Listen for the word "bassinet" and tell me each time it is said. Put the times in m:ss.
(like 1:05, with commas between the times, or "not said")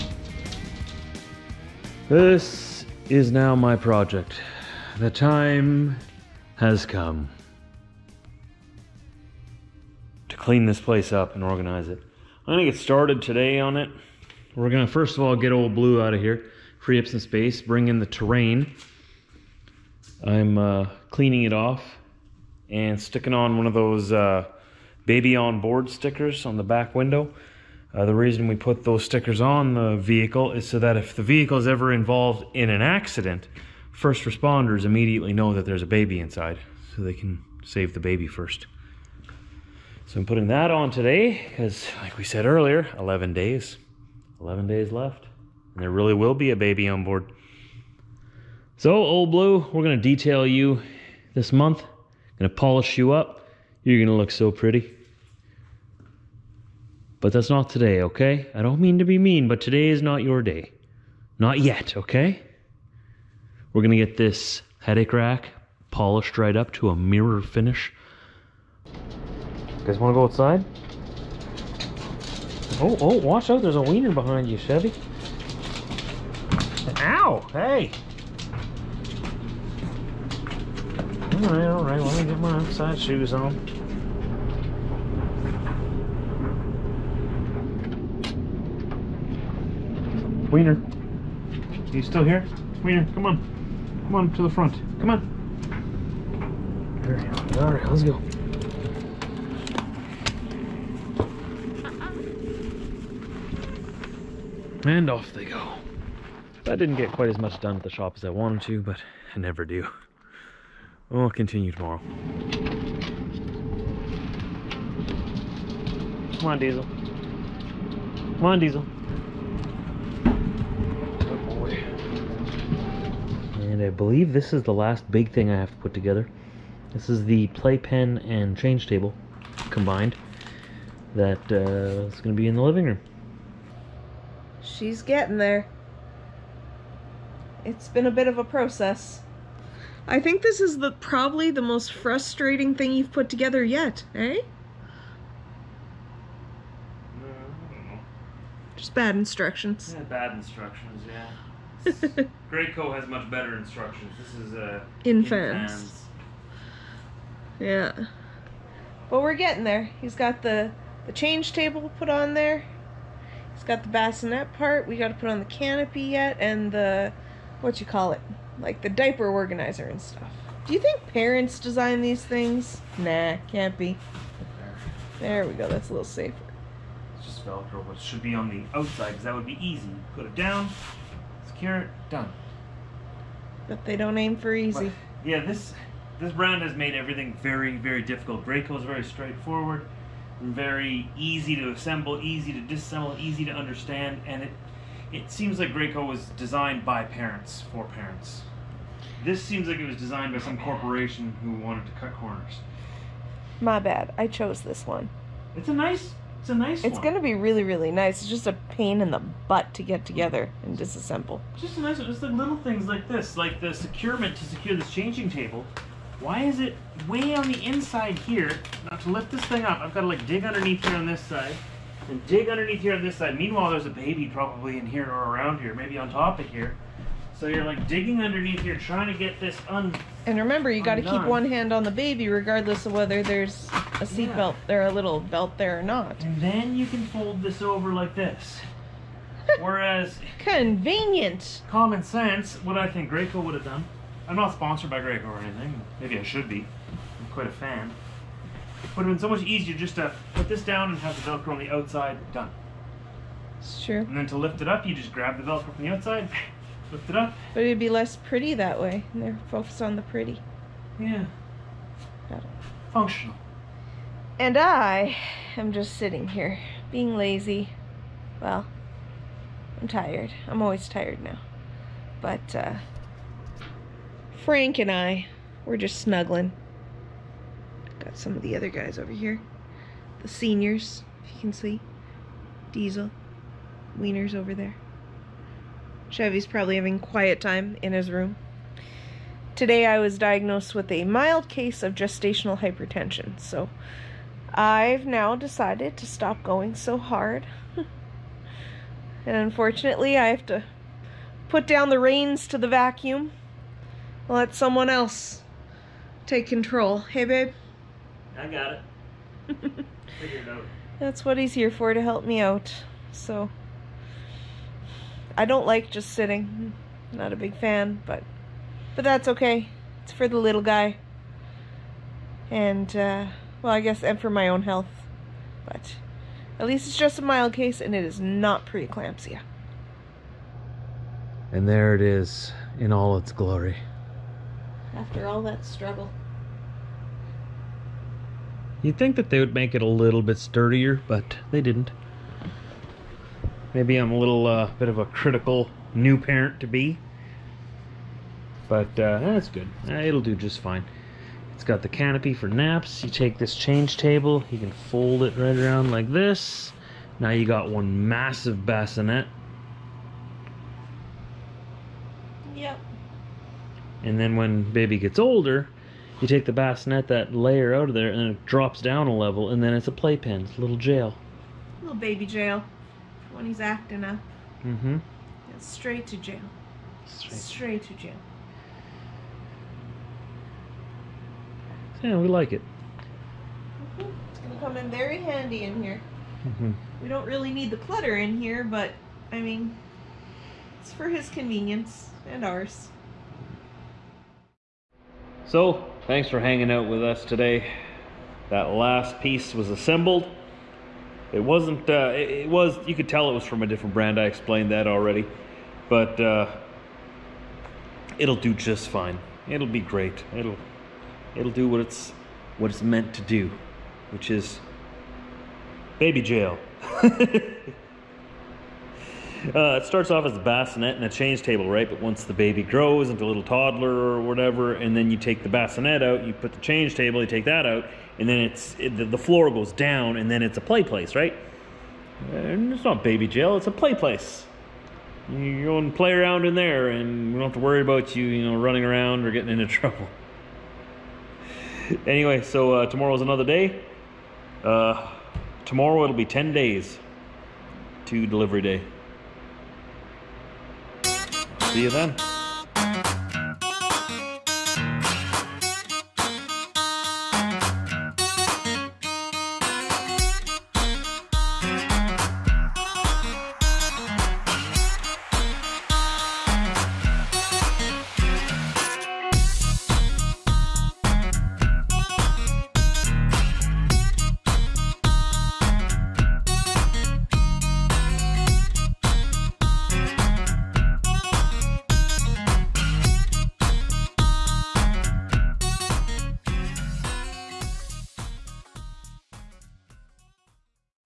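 2:43, 5:58, 6:06, 7:00, 7:05.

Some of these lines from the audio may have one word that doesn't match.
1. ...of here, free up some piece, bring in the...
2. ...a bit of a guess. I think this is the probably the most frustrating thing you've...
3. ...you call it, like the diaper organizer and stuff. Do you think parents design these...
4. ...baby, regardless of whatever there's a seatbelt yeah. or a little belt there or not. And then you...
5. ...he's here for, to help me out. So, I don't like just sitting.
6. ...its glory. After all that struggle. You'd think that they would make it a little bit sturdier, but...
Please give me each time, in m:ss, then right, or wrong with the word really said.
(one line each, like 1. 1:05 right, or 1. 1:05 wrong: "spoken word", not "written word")
1. 0:16 wrong: "space", not "piece"
2. 2:18 wrong: "process", not "guess"
3. 2:47 right
4. 3:51 wrong: "whether", not "whatever"
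5. 5:11 right
6. 5:33 right.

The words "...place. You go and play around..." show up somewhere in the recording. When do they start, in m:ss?
7:13.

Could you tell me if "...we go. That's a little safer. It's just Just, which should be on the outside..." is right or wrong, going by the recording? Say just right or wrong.
wrong.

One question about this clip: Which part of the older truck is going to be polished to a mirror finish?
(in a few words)
Headache rack.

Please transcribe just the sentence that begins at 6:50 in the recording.
It'll it'll do what it's what it's meant to do, which is baby jail.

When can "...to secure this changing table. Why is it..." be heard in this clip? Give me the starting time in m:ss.
3:34.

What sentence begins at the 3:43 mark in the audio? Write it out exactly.
Meanwhile, there's a baby probably in here or around here, maybe on top of here.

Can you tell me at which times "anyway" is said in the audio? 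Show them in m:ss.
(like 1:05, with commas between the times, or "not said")
7:22.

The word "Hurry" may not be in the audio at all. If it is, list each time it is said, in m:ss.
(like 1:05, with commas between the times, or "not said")
1:37.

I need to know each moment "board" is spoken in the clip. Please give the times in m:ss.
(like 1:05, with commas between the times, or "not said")
0:25, 0:47.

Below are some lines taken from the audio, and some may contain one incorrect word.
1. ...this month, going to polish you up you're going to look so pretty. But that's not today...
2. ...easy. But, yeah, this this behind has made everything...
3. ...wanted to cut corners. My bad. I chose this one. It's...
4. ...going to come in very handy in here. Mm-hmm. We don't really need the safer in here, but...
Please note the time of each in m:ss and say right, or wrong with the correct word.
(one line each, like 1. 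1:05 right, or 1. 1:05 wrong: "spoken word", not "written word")
1. 0:51 right
2. 3:04 wrong: "brand", not "behind"
3. 3:21 right
4. 6:24 wrong: "clutter", not "safer".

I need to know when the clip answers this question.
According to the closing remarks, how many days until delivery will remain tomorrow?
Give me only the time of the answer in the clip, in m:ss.
7:26.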